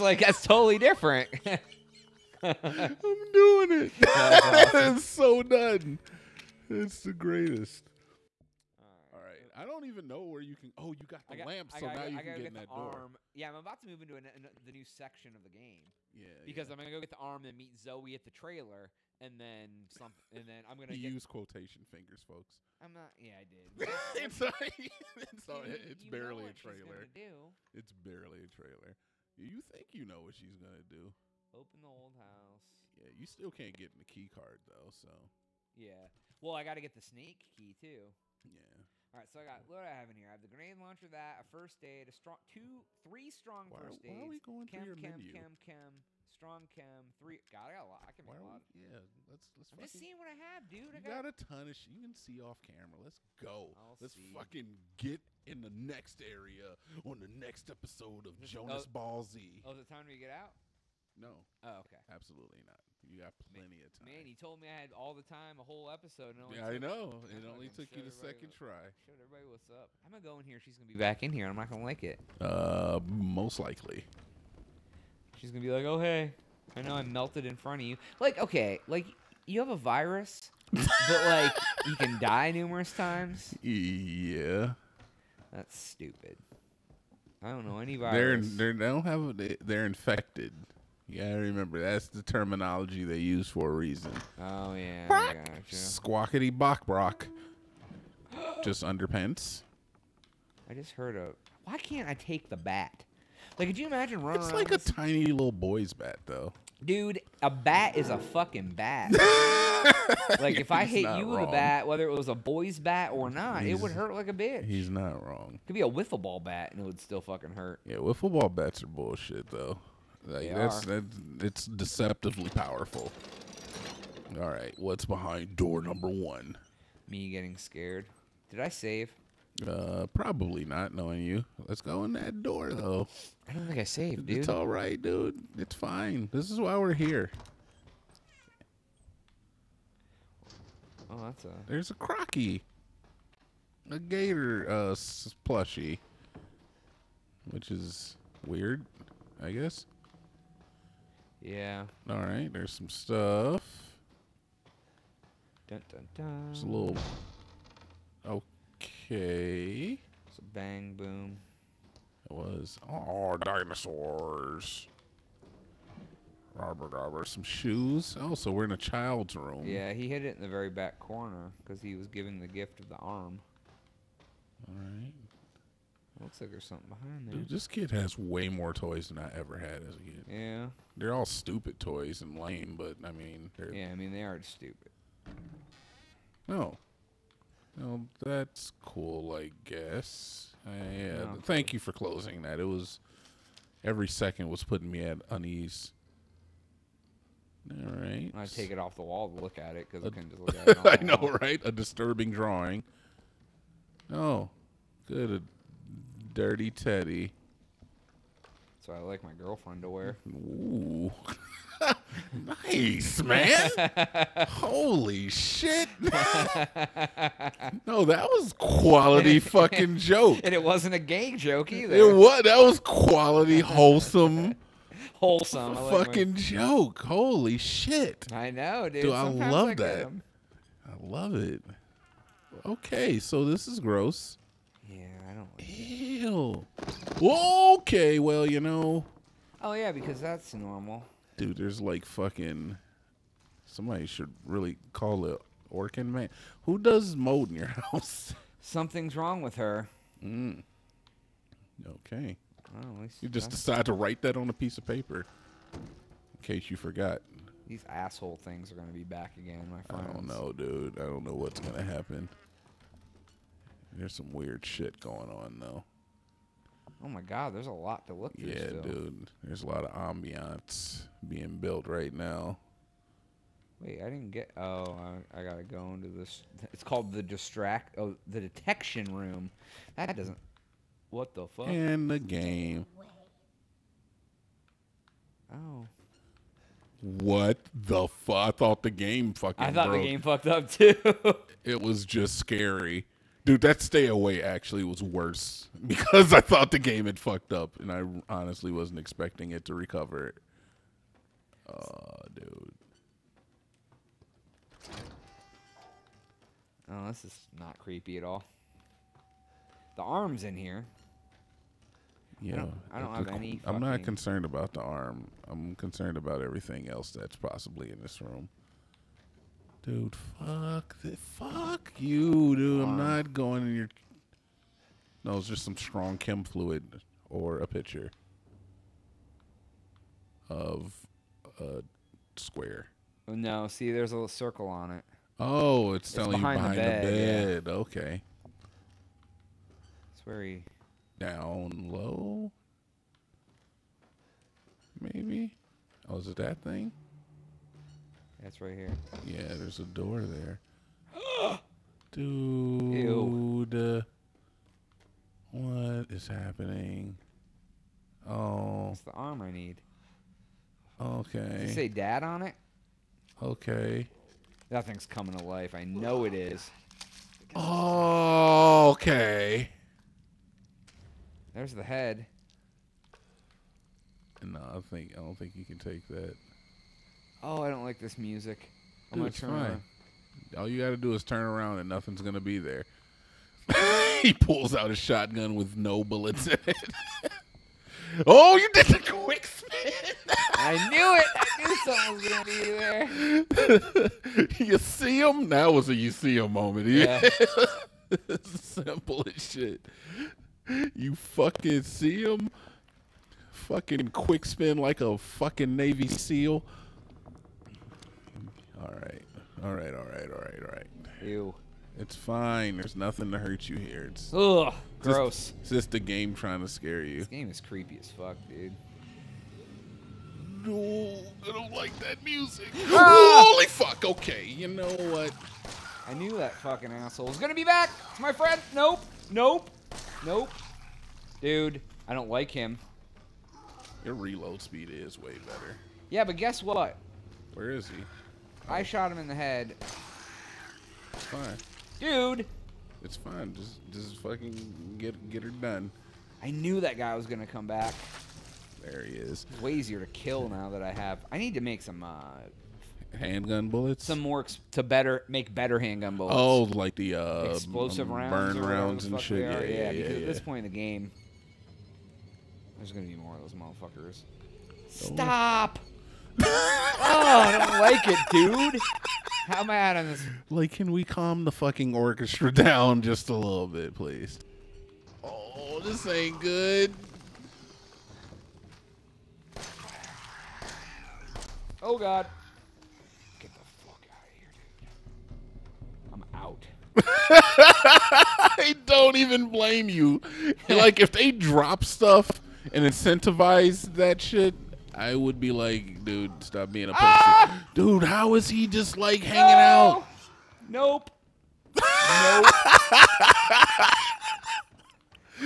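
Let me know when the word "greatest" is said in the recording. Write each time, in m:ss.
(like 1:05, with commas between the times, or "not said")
0:07.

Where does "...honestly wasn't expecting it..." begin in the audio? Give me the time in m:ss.
4:58.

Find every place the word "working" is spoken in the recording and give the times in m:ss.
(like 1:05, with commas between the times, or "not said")
not said.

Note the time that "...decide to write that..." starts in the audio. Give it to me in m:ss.
4:13.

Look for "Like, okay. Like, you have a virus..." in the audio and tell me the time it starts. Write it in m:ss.
1:18.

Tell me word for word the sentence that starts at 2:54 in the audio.
All right, Looks like there's something behind there.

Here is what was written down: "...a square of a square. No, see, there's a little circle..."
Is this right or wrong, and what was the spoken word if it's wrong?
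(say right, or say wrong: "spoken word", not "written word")
wrong: "picture", not "square".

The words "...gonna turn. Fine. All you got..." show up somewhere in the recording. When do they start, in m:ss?
6:19.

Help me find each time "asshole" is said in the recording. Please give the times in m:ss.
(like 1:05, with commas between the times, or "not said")
4:17, 7:06.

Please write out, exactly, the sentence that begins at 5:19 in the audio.
Dude, fuck the fuck you, dude not going in your.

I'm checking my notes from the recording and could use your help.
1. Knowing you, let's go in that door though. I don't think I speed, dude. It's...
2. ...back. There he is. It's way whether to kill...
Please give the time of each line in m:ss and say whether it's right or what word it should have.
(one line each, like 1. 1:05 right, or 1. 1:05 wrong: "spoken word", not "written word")
1. 2:10 wrong: "saved", not "speed"
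2. 7:27 wrong: "easier", not "whether".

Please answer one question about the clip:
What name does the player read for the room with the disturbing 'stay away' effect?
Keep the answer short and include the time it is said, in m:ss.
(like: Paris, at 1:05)
The detection room, at 4:38.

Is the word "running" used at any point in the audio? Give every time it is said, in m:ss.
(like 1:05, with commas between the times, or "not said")
1:44.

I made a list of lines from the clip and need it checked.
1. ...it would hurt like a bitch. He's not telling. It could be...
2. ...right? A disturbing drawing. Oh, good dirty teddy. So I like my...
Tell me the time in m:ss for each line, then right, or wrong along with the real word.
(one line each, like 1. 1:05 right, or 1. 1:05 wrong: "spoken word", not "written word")
1. 1:53 wrong: "wrong", not "telling"
2. 3:21 right.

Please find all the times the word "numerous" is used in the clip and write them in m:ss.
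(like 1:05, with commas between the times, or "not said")
1:22.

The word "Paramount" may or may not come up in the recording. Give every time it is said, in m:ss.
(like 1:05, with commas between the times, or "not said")
not said.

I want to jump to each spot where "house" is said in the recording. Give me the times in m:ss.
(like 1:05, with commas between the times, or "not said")
0:32, 4:07.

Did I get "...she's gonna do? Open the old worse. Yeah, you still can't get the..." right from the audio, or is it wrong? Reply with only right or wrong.
wrong.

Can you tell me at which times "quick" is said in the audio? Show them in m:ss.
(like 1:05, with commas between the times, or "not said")
6:28, 6:44.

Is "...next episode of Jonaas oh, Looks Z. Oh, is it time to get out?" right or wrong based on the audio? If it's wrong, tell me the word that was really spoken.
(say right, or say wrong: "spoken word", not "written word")
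wrong: "Ball", not "Looks".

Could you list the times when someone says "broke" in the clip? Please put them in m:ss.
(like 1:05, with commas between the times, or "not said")
4:49.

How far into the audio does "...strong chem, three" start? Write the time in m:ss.
0:46.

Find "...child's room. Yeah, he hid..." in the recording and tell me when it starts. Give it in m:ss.
2:48.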